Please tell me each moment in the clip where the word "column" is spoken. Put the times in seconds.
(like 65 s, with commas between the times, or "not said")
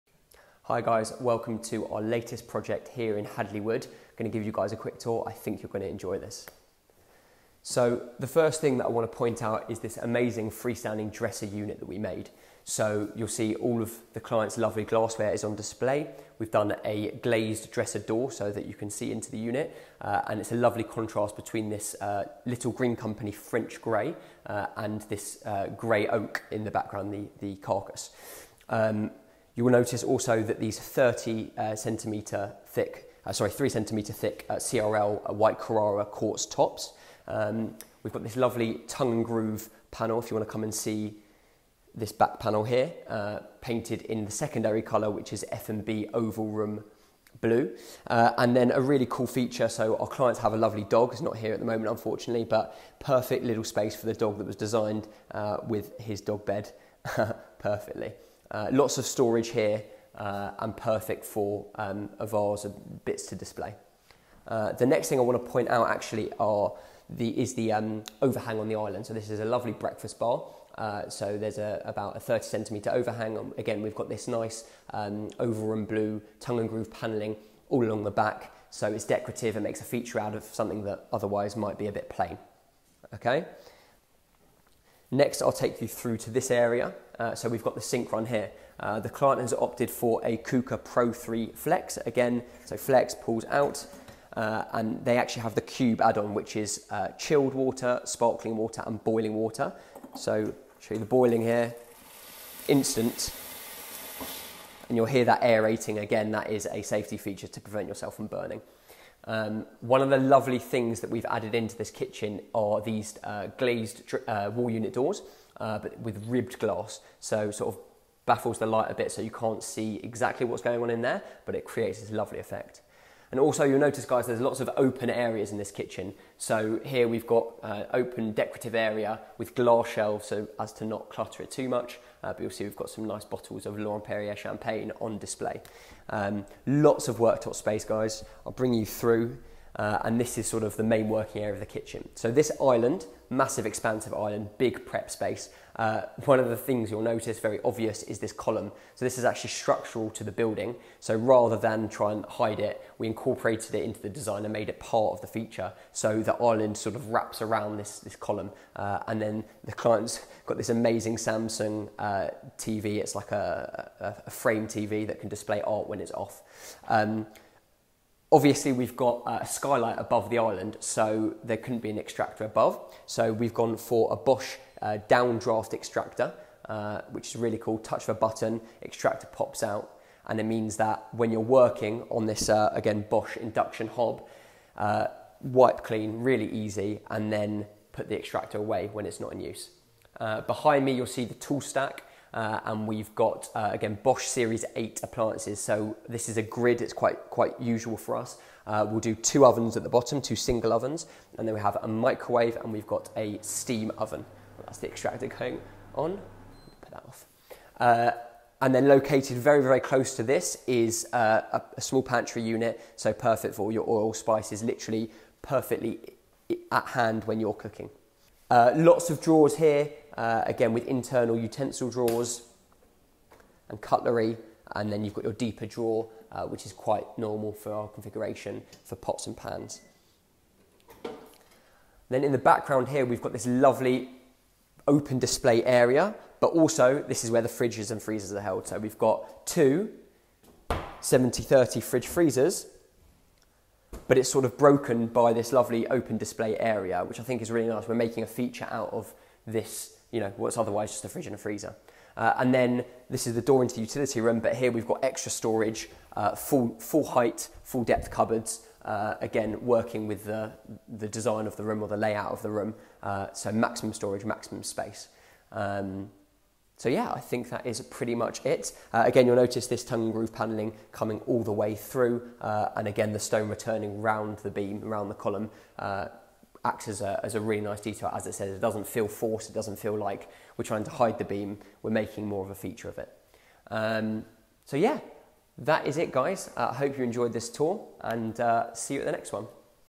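148 s, 158 s, 275 s.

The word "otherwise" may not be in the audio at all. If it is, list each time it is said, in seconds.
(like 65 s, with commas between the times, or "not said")
81 s, 250 s.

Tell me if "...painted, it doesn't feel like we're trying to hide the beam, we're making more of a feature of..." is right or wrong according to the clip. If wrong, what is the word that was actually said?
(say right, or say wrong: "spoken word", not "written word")
wrong: "forced", not "painted".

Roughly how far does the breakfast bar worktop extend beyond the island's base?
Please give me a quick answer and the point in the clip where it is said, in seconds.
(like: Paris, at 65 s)
30 centimetres, at 72 s.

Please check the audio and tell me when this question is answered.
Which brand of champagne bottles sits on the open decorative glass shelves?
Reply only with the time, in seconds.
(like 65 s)
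133 s.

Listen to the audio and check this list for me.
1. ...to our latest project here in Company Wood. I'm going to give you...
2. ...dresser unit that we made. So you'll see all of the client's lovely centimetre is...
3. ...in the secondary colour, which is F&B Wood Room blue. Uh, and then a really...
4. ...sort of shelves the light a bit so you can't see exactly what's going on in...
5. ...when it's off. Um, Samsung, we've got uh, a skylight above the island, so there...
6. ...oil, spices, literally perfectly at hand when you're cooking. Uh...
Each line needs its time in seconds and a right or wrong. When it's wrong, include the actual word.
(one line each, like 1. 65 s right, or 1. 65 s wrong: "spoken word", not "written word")
1. 1 s wrong: "Hadley", not "Company"
2. 11 s wrong: "glassware", not "centimetre"
3. 44 s wrong: "Oval", not "Wood"
4. 117 s wrong: "baffles", not "shelves"
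5. 165 s wrong: "Obviously", not "Samsung"
6. 213 s right.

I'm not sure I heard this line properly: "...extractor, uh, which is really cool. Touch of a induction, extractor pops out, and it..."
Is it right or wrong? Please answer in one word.
wrong.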